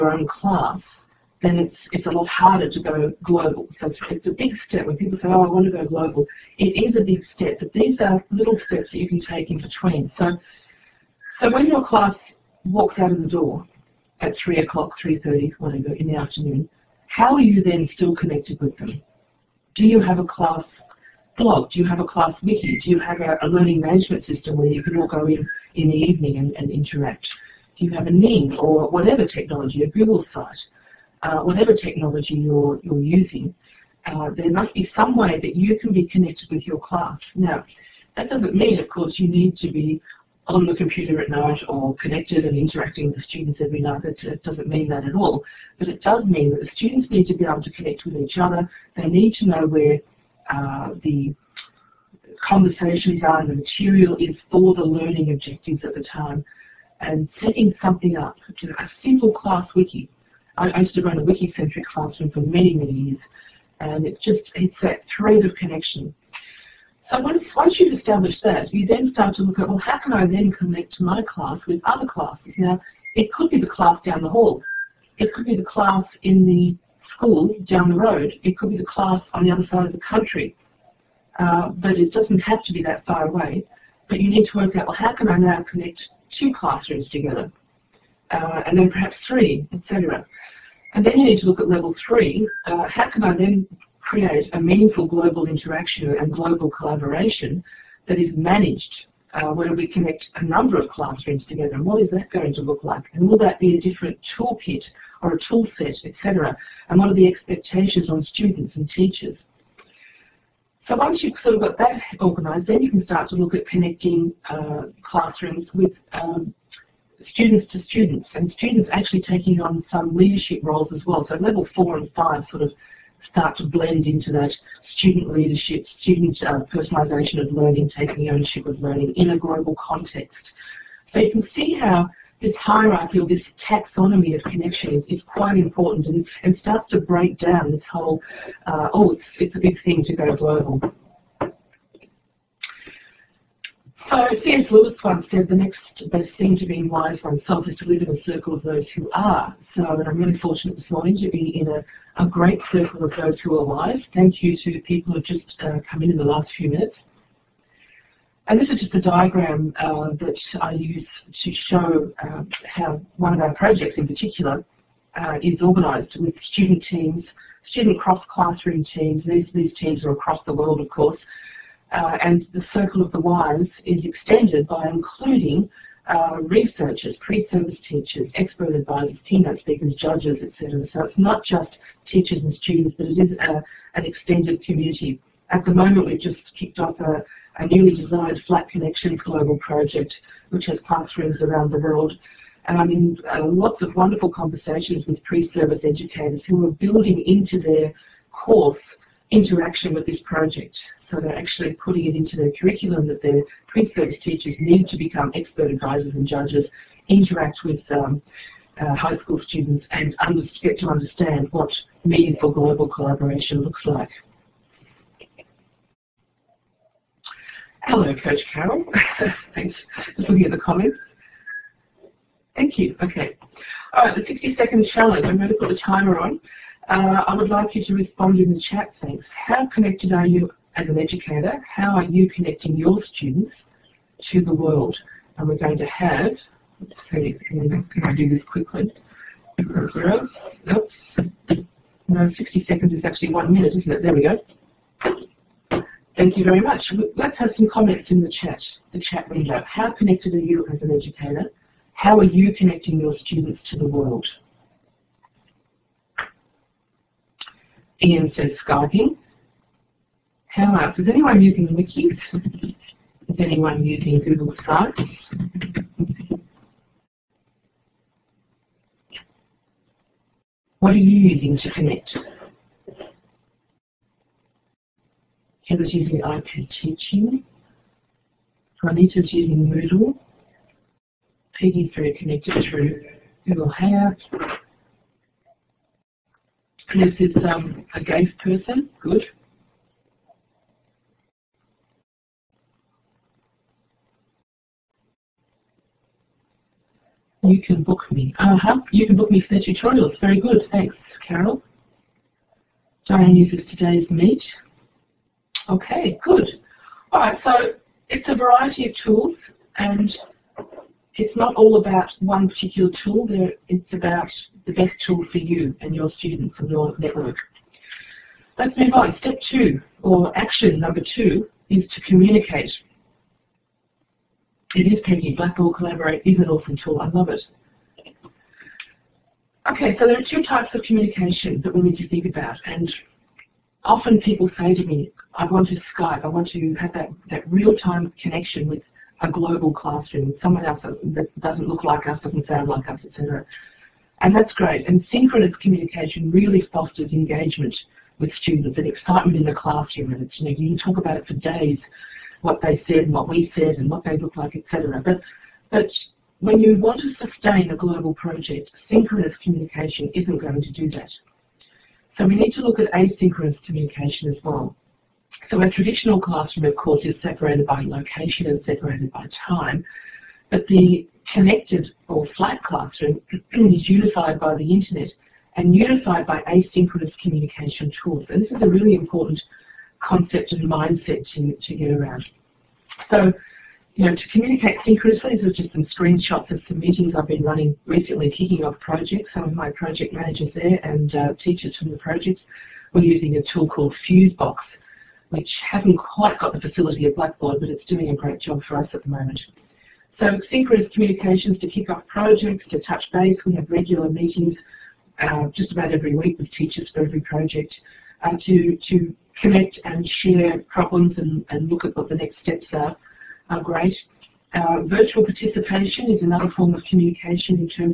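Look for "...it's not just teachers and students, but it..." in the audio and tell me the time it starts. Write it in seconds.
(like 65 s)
181 s.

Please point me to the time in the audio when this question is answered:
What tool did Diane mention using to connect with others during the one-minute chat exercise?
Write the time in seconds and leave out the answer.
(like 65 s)
303 s.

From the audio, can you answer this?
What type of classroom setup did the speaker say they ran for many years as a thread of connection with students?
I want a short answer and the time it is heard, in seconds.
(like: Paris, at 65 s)
wiki-centric classroom, at 61 s.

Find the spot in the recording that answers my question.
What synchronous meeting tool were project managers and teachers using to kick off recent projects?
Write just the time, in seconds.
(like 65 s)
394 s.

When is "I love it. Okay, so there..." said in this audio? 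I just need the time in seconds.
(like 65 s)
326 s.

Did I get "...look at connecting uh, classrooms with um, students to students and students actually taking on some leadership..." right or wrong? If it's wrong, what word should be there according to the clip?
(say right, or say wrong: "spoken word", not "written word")
right.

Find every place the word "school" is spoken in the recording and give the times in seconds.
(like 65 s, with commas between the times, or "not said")
77 s, 209 s.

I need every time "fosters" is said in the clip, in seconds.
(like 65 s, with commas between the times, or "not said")
346 s.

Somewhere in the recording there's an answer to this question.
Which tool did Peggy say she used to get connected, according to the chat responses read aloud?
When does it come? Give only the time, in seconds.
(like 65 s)
283 s.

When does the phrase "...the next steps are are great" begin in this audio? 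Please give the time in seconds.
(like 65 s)
412 s.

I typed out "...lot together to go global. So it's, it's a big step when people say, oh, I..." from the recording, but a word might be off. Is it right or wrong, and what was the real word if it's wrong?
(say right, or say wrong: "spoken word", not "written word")
wrong: "harder", not "together".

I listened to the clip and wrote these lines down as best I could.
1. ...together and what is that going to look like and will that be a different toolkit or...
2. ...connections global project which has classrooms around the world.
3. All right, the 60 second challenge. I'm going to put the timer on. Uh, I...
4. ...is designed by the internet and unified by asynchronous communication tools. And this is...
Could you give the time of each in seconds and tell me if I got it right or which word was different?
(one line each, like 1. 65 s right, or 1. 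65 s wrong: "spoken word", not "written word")
1. 101 s right
2. 188 s right
3. 223 s right
4. 373 s wrong: "unified", not "designed".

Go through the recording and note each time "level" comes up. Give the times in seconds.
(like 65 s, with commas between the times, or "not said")
91 s, 121 s.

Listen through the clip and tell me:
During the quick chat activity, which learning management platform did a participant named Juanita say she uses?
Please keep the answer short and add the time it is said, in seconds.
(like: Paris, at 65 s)
Moodle, at 279 s.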